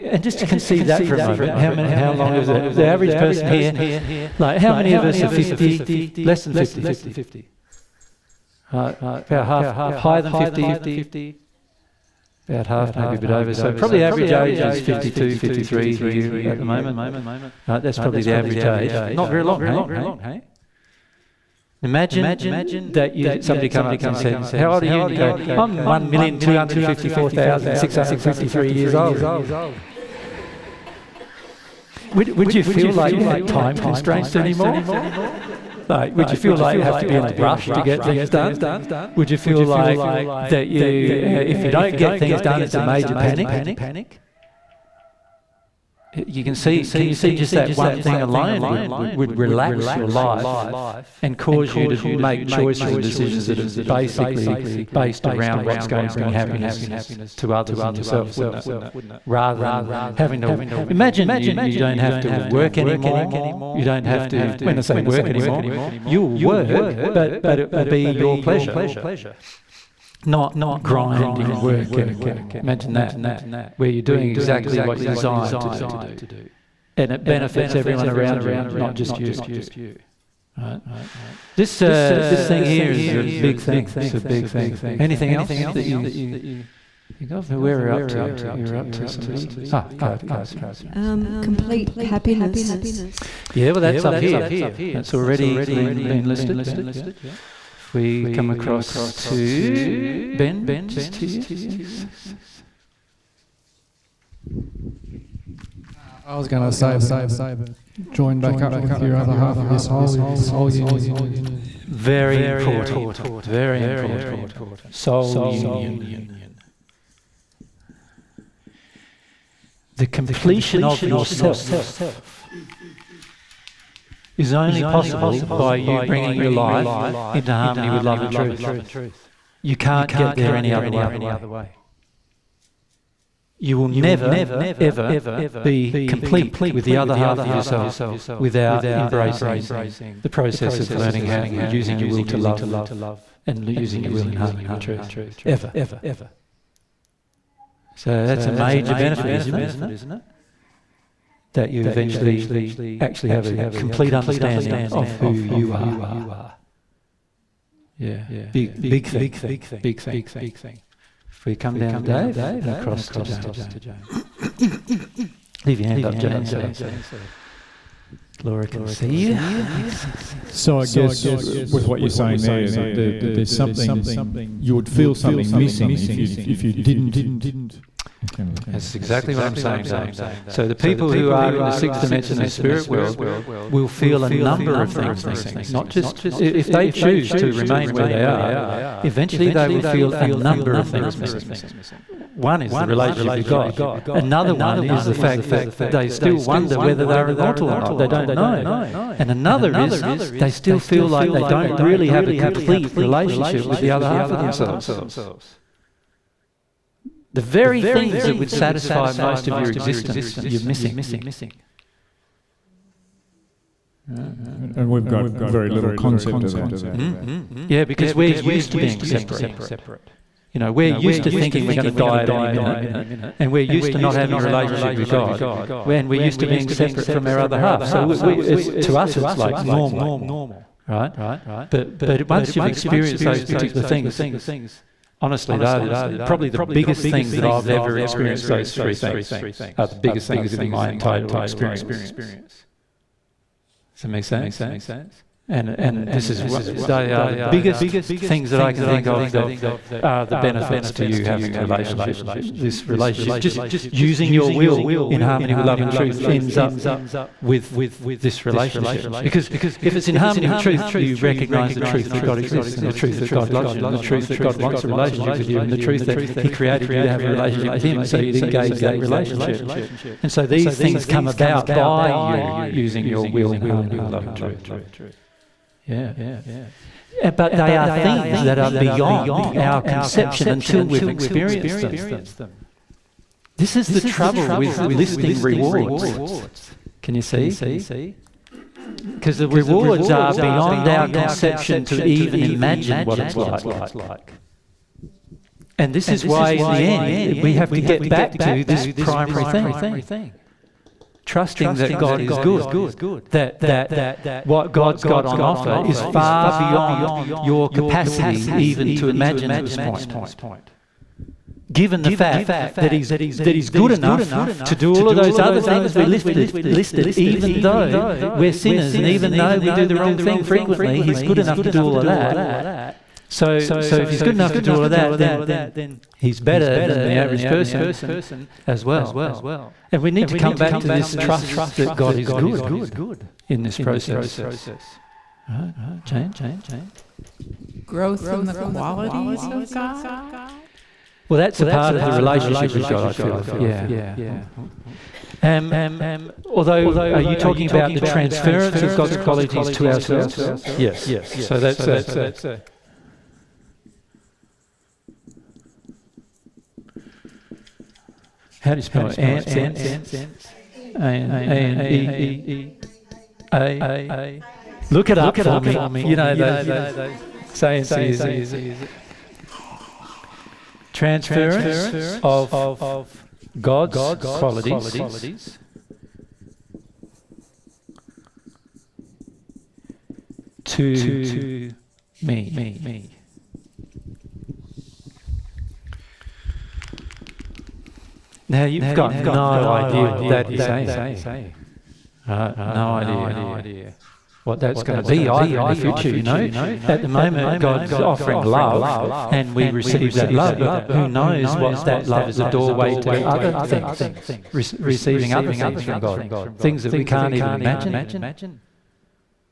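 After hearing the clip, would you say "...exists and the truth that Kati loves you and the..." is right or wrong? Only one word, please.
wrong.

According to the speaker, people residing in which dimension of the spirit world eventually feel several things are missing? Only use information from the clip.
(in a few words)
sixth dimension.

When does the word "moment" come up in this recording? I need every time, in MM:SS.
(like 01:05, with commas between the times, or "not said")
00:01, 00:16, 06:37.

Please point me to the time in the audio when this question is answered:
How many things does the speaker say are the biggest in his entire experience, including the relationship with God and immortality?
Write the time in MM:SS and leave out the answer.
03:58.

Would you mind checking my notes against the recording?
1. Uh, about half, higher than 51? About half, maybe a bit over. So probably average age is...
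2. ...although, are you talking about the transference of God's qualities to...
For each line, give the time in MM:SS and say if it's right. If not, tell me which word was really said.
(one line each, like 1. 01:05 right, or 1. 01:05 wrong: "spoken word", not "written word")
1. 00:08 wrong: "50", not "51"
2. 05:46 right.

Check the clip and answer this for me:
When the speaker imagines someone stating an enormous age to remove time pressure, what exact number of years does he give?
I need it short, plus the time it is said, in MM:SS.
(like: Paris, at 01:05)
1,254,653, at 00:25.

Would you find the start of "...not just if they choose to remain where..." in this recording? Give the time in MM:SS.
03:05.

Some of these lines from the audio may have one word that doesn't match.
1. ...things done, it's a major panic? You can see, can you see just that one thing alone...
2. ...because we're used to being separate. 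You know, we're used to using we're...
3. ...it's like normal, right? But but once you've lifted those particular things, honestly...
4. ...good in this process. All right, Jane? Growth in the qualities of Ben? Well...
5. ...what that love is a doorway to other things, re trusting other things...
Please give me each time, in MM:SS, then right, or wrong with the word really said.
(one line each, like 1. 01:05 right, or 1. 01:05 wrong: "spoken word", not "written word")
1. 00:42 right
2. 03:37 wrong: "thinking", not "using"
3. 03:49 wrong: "experienced", not "lifted"
4. 05:32 wrong: "God", not "Ben"
5. 06:41 wrong: "receiving", not "trusting".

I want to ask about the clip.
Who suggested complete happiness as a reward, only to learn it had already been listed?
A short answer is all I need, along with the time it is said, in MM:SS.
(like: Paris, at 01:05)
Kati, at 01:29.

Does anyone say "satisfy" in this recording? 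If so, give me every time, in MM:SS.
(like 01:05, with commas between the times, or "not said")
03:28.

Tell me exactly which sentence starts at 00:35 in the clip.
like, would you feel like you have to be in a rush to get things done?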